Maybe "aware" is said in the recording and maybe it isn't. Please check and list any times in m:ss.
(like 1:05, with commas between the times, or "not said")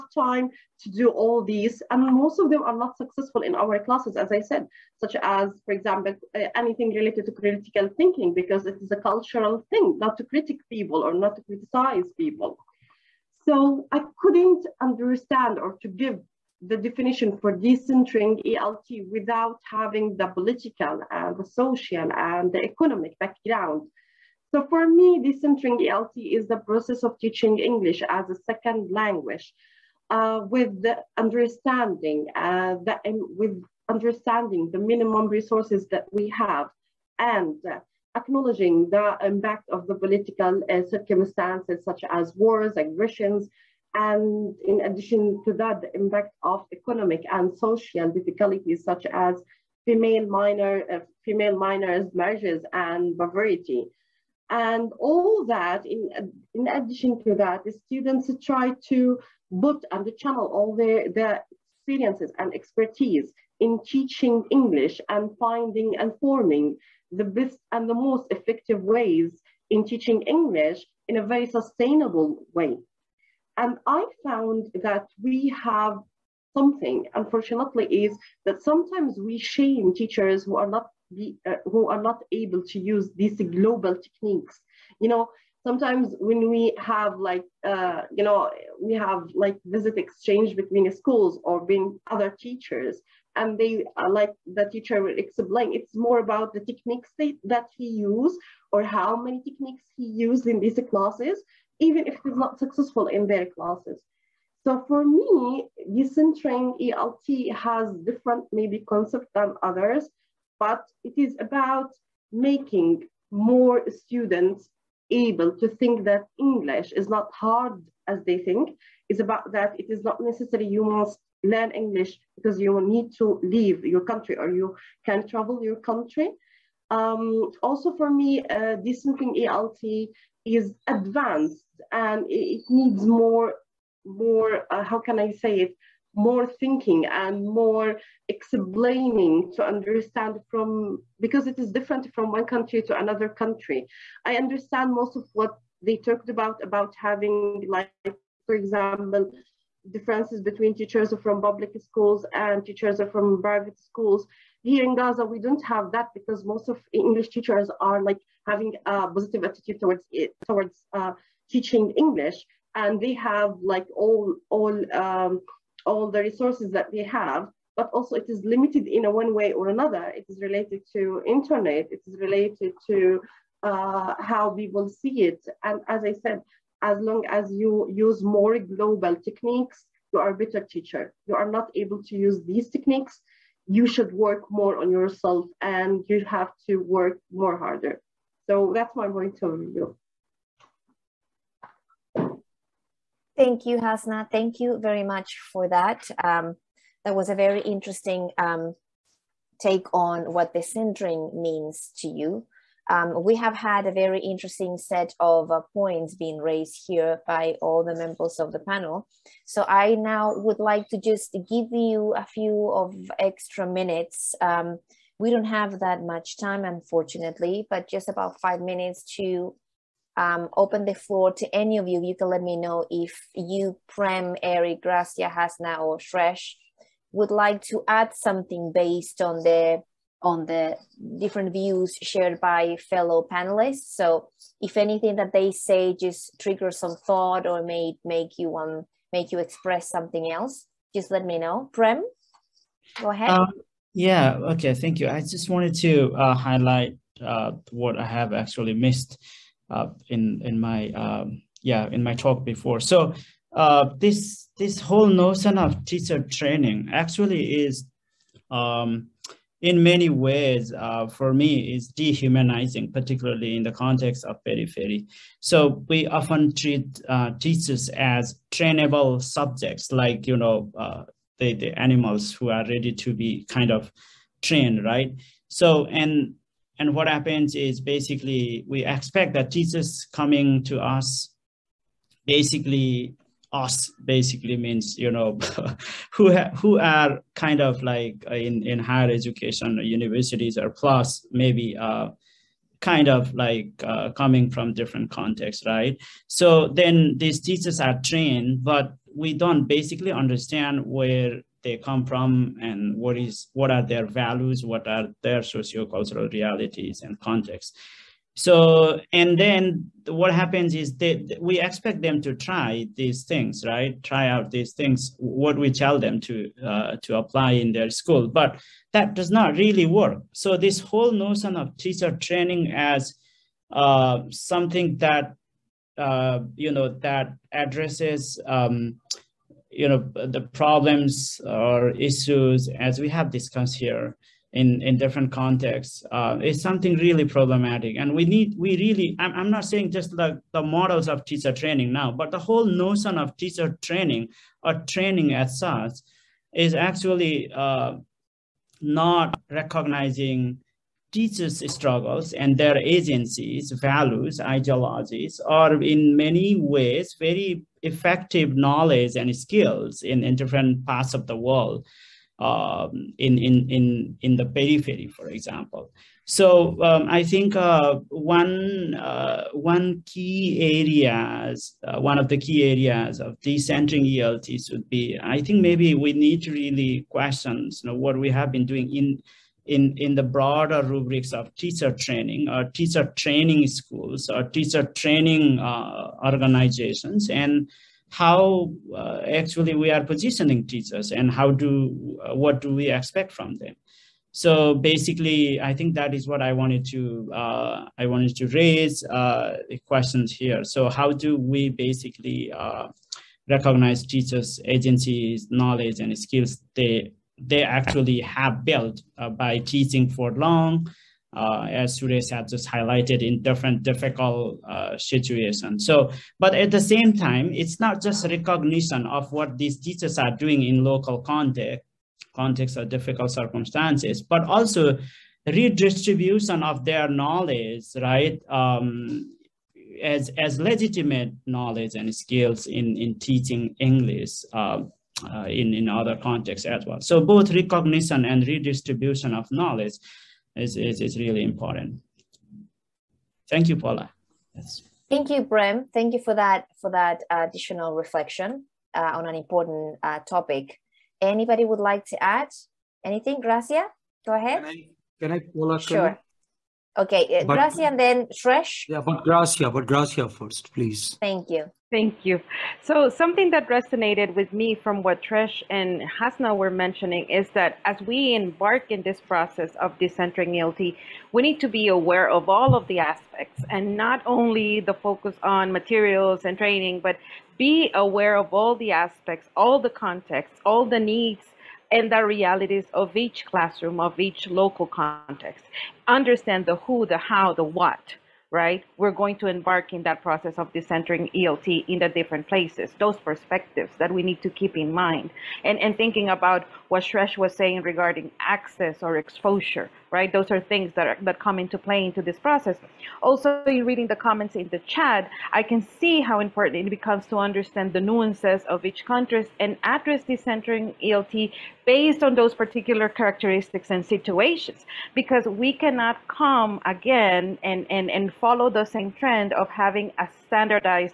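7:51, 7:57.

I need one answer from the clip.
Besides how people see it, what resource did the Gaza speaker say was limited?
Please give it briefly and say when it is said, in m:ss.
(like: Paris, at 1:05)
Internet, at 2:51.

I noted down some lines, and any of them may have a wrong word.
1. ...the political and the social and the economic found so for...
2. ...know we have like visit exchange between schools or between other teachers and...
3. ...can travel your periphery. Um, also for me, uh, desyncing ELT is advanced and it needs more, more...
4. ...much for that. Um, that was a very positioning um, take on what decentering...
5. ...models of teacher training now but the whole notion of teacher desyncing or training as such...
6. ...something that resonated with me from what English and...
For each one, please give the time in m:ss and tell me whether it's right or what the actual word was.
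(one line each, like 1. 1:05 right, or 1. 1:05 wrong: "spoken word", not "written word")
1. 0:20 wrong: "background", not "found"
2. 1:28 right
3. 2:05 wrong: "country", not "periphery"
4. 3:15 wrong: "interesting", not "positioning"
5. 5:40 wrong: "training", not "desyncing"
6. 7:43 wrong: "Shreesh", not "English".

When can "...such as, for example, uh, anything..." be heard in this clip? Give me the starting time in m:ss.
0:05.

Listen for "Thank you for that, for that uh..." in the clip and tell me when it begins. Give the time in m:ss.
7:25.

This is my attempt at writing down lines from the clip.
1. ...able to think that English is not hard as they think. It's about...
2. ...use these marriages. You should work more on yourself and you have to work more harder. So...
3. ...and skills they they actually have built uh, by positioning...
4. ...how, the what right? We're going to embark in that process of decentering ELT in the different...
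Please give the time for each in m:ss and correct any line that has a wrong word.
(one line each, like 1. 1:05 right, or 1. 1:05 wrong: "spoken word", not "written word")
1. 1:55 right
2. 3:02 wrong: "techniques", not "marriages"
3. 6:45 wrong: "teaching", not "positioning"
4. 8:07 right.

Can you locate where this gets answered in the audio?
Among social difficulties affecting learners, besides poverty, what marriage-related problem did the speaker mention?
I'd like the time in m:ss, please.
0:51.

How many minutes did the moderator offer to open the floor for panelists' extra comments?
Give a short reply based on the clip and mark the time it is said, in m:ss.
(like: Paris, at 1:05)
5, at 3:38.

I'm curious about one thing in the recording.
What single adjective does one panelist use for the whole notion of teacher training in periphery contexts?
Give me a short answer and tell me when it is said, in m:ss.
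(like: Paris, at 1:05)
Dehumanizing, at 4:21.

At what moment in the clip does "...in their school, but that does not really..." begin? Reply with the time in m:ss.
5:17.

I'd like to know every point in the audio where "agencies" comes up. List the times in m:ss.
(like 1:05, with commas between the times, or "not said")
5:52, 6:44.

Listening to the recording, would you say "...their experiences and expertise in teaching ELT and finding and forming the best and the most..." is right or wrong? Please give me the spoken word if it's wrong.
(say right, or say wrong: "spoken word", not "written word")
wrong: "English", not "ELT".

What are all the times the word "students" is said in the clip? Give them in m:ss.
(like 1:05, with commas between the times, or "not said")
0:57, 1:53.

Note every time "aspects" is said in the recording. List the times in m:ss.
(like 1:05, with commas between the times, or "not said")
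7:52, 7:58.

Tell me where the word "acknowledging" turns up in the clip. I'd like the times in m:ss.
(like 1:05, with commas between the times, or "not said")
0:38.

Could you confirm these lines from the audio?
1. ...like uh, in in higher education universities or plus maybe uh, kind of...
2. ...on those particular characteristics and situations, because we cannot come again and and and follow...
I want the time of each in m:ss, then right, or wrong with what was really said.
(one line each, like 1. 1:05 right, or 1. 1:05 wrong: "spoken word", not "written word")
1. 4:47 right
2. 8:32 right.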